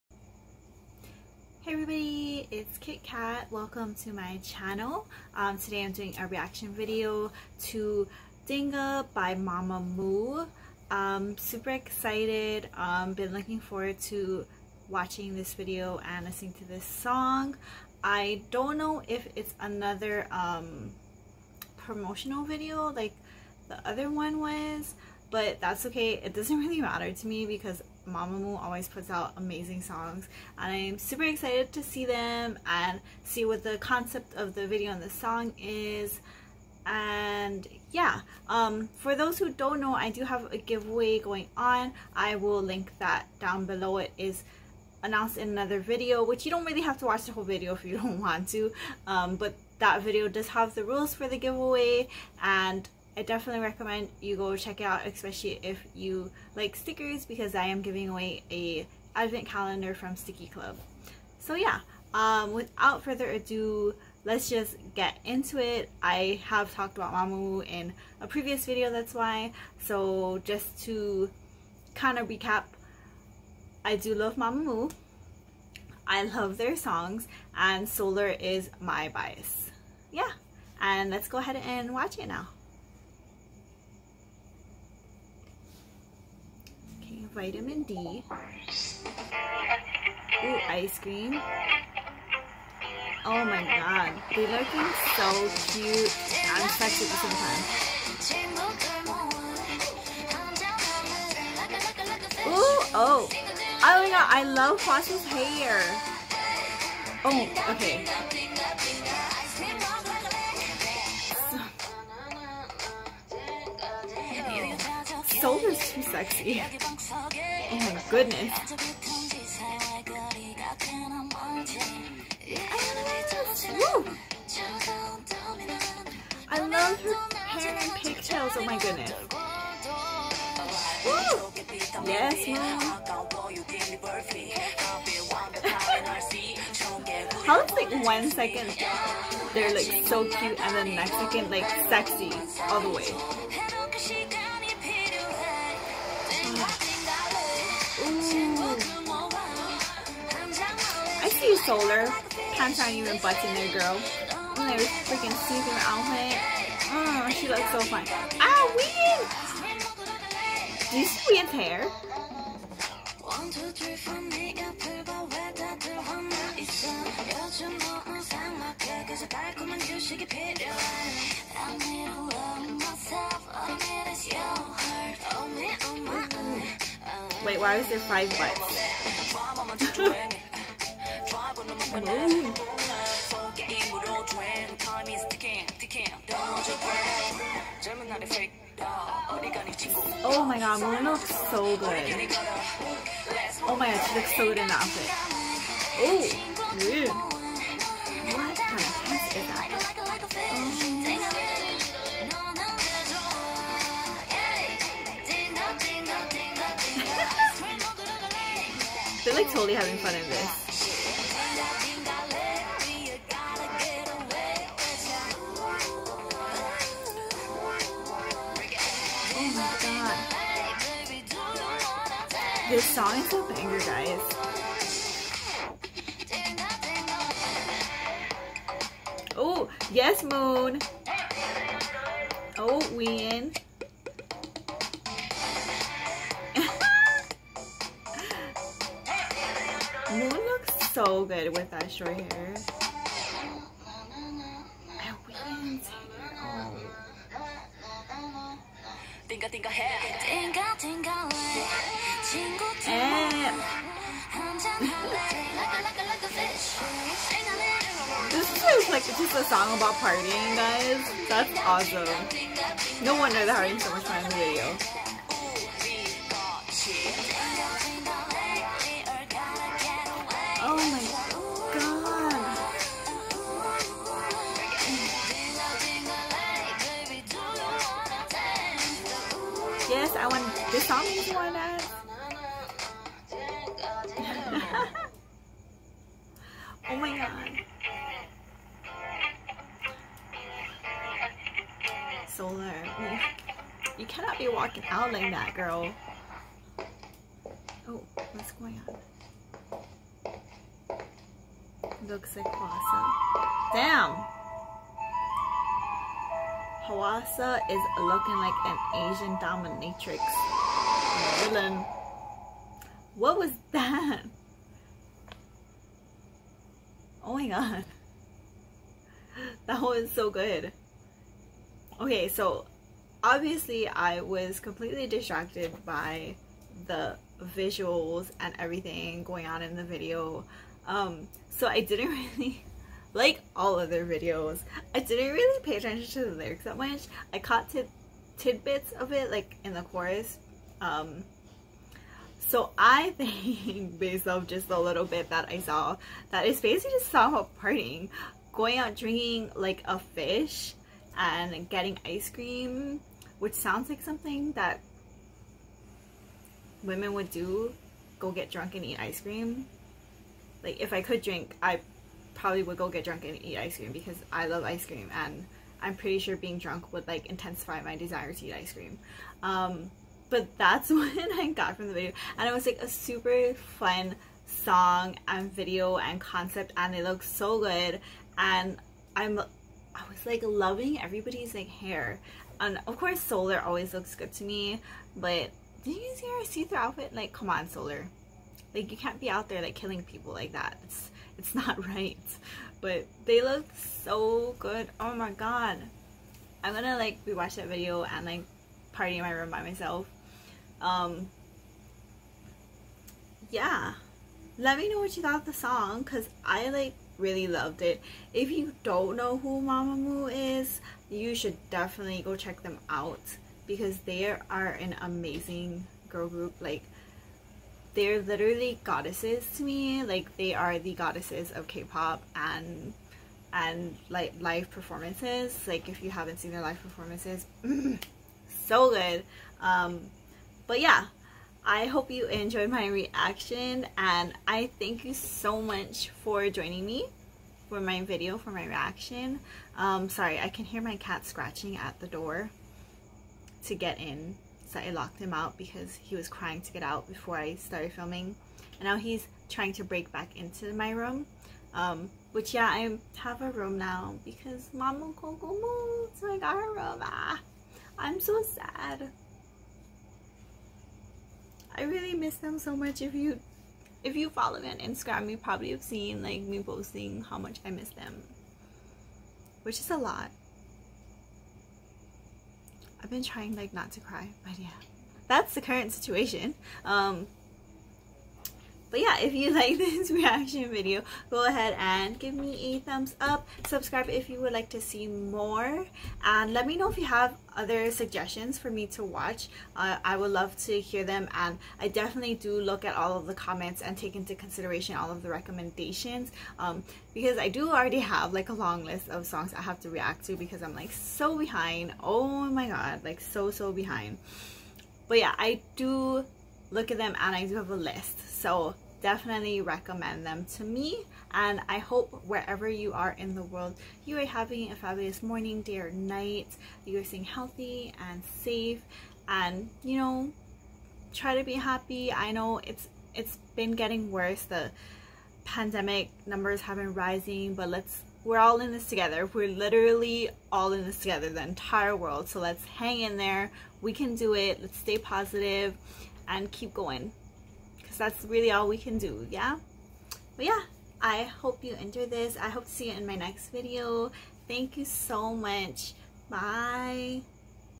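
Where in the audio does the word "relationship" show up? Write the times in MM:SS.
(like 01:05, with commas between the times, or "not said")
not said.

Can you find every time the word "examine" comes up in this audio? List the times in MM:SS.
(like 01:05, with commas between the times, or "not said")
not said.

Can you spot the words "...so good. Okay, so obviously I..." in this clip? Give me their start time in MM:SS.
05:20.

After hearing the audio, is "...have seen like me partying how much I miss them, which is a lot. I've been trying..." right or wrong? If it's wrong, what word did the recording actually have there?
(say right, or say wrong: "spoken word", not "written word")
wrong: "posting", not "partying".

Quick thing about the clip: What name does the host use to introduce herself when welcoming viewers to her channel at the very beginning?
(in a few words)
Kit Cat.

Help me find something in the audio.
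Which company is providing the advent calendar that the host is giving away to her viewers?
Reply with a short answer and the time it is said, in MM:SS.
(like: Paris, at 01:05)
Stickii Club, at 01:00.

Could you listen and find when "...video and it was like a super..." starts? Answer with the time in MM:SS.
06:11.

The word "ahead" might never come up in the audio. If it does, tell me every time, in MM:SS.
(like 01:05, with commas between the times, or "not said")
01:21, 08:01.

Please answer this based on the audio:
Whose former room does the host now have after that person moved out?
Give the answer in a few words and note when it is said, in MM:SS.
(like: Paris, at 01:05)
Mama Coco, at 07:34.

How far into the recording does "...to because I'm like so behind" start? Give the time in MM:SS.
08:20.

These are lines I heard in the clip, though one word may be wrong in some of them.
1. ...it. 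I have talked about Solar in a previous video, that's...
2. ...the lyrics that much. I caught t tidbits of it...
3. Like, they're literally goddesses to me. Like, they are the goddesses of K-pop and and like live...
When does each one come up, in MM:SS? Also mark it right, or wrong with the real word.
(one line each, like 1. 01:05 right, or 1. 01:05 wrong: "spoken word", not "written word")
1. 01:05 wrong: "Mamamoo", not "Solar"
2. 05:36 right
3. 06:56 right.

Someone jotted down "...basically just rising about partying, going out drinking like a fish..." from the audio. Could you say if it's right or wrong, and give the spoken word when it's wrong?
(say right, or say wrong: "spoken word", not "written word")
wrong: "talking", not "rising".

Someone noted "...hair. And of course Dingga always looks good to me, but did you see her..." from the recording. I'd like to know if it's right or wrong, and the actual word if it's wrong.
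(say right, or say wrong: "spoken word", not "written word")
wrong: "Solar", not "Dingga".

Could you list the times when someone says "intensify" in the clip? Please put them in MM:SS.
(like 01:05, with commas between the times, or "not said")
06:07.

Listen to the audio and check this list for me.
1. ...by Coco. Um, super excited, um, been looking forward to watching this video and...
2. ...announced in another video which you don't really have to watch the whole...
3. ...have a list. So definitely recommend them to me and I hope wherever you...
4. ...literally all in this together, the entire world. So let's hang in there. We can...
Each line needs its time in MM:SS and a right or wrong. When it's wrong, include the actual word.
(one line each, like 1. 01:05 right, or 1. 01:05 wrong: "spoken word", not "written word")
1. 00:09 wrong: "Mamamoo", not "Coco"
2. 00:45 right
3. 08:27 right
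4. 08:49 right.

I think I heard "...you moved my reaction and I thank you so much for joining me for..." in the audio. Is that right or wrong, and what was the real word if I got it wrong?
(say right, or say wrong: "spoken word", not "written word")
wrong: "enjoyed", not "moved".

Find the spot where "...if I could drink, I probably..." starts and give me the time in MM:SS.
06:00.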